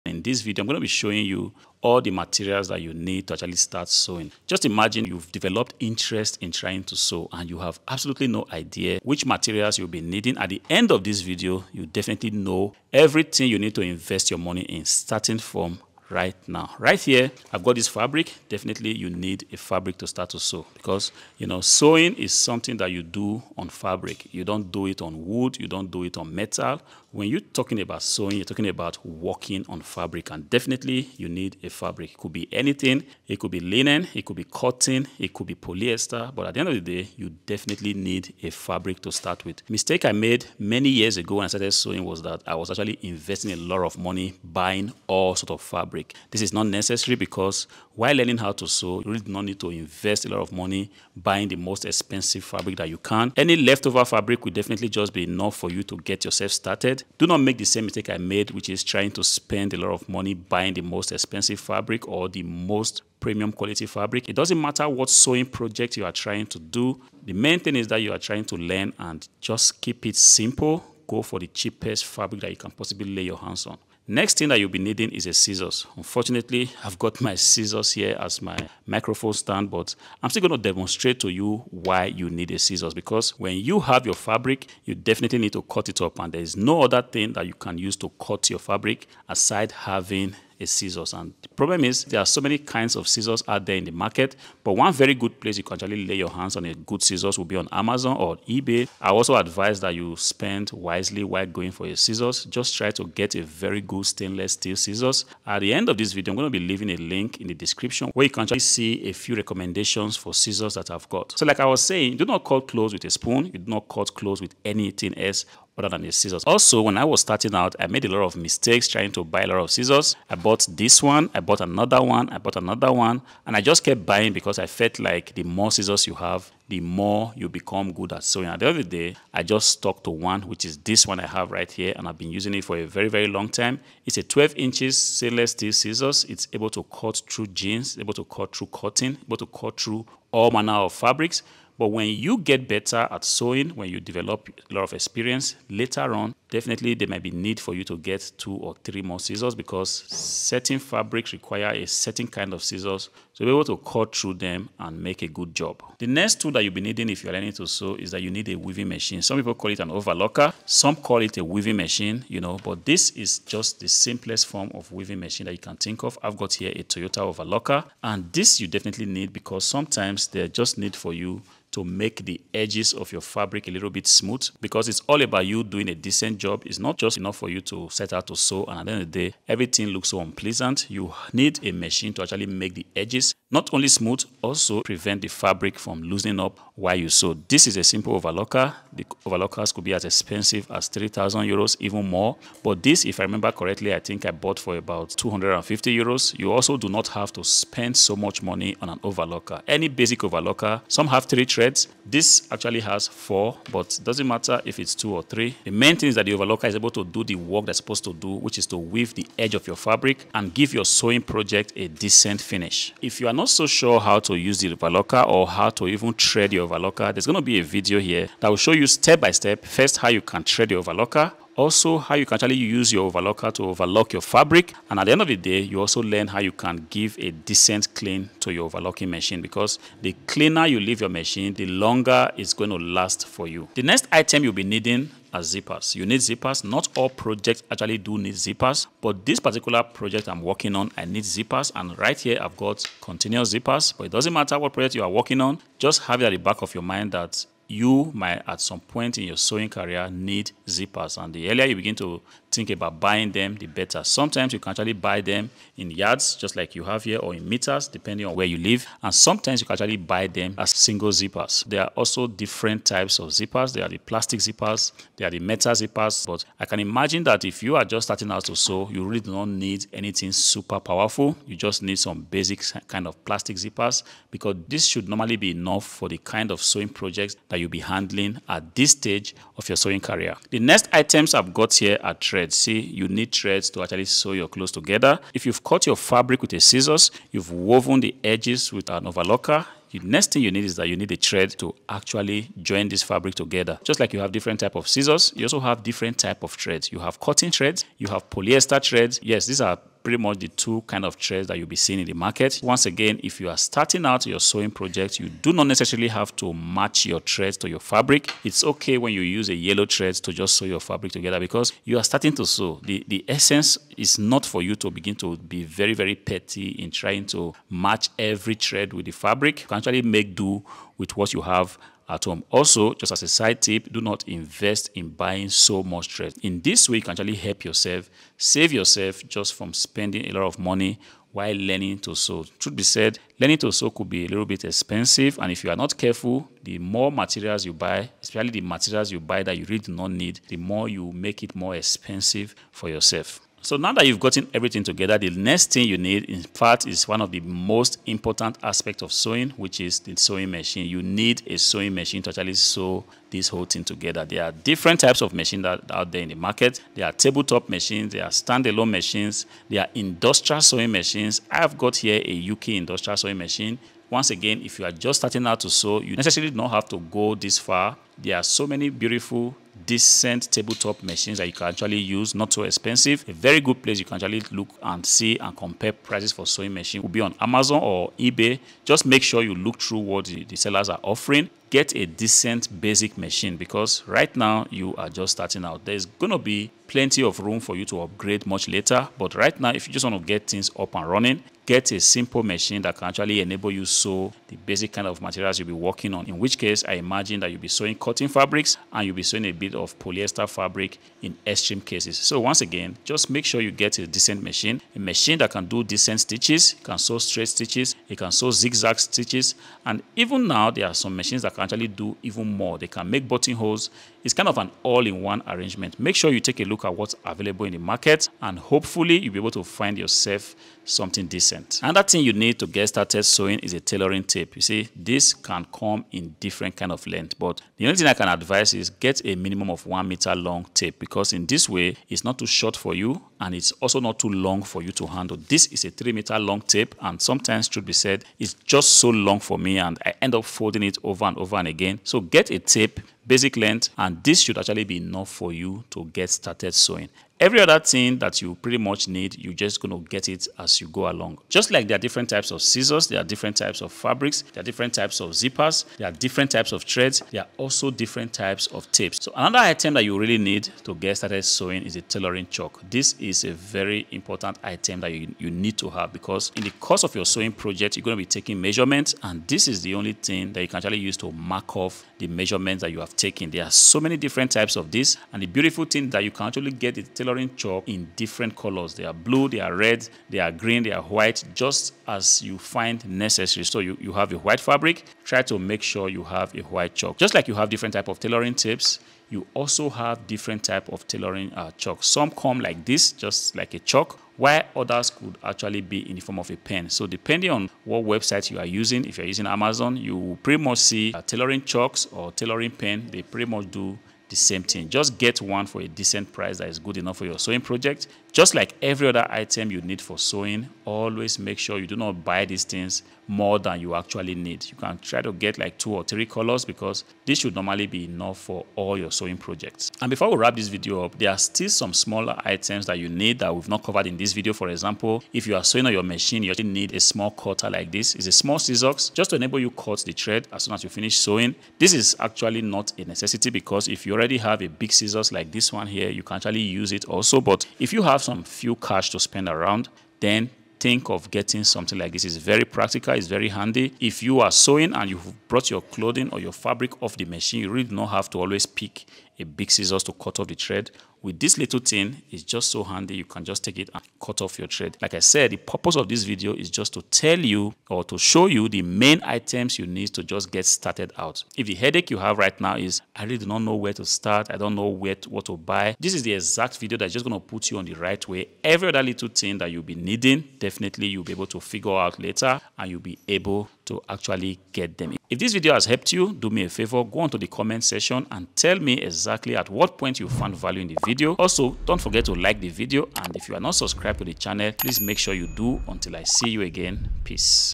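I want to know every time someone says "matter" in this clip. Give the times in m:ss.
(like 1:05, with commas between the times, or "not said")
1:04, 3:24, 4:04.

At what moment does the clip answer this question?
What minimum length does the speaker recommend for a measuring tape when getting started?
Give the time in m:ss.
7:09.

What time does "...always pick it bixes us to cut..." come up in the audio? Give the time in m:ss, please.
9:08.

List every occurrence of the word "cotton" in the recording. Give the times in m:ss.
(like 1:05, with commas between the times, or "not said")
0:34, 2:18, 4:57, 6:37.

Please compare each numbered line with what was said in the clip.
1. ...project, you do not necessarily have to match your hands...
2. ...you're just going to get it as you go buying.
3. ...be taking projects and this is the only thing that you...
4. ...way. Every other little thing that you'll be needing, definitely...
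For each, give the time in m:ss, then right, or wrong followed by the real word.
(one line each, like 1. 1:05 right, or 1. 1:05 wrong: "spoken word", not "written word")
1. 5:04 wrong: "threads", not "hands"
2. 7:29 wrong: "along", not "buying"
3. 7:48 wrong: "measurements", not "projects"
4. 9:28 right.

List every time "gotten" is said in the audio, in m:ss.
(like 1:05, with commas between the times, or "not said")
5:44.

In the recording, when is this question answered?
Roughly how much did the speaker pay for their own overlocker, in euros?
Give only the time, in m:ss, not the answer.
3:15.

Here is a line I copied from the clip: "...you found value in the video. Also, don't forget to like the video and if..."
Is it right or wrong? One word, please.
right.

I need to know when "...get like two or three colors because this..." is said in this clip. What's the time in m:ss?
8:35.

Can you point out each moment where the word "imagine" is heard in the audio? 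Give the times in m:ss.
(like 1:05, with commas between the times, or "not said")
0:04, 4:26, 6:36.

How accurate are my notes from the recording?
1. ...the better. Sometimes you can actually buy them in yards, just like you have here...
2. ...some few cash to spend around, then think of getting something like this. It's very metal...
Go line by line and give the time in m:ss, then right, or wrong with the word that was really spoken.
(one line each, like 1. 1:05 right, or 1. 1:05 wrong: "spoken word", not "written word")
1. 4:13 right
2. 8:58 wrong: "practical", not "metal".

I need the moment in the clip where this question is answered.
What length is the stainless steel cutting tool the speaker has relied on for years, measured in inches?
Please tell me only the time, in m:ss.
2:14.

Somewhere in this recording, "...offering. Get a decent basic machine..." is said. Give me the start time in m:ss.
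6:21.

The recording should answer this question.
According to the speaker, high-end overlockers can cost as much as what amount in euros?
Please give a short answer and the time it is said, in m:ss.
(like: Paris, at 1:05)
3,000 euros, at 3:10.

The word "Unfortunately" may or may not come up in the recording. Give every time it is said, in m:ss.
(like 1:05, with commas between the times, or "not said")
1:15.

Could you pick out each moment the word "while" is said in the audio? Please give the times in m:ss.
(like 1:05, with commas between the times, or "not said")
0:47, 1:41, 3:06, 5:31, 8:14.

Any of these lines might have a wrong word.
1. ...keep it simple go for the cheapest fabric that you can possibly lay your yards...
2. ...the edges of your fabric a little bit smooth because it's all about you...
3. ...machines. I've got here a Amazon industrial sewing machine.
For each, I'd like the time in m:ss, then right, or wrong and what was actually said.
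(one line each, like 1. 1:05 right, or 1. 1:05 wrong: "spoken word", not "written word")
1. 1:09 wrong: "hands", not "yards"
2. 2:52 right
3. 6:00 wrong: "Juki", not "Amazon".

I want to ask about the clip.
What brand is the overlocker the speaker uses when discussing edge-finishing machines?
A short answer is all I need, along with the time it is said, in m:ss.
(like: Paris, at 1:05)
Toyota, at 2:46.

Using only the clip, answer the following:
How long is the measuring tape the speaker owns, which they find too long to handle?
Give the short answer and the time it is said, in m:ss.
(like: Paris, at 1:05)
3 meters, at 7:15.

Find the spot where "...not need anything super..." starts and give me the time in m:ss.
4:29.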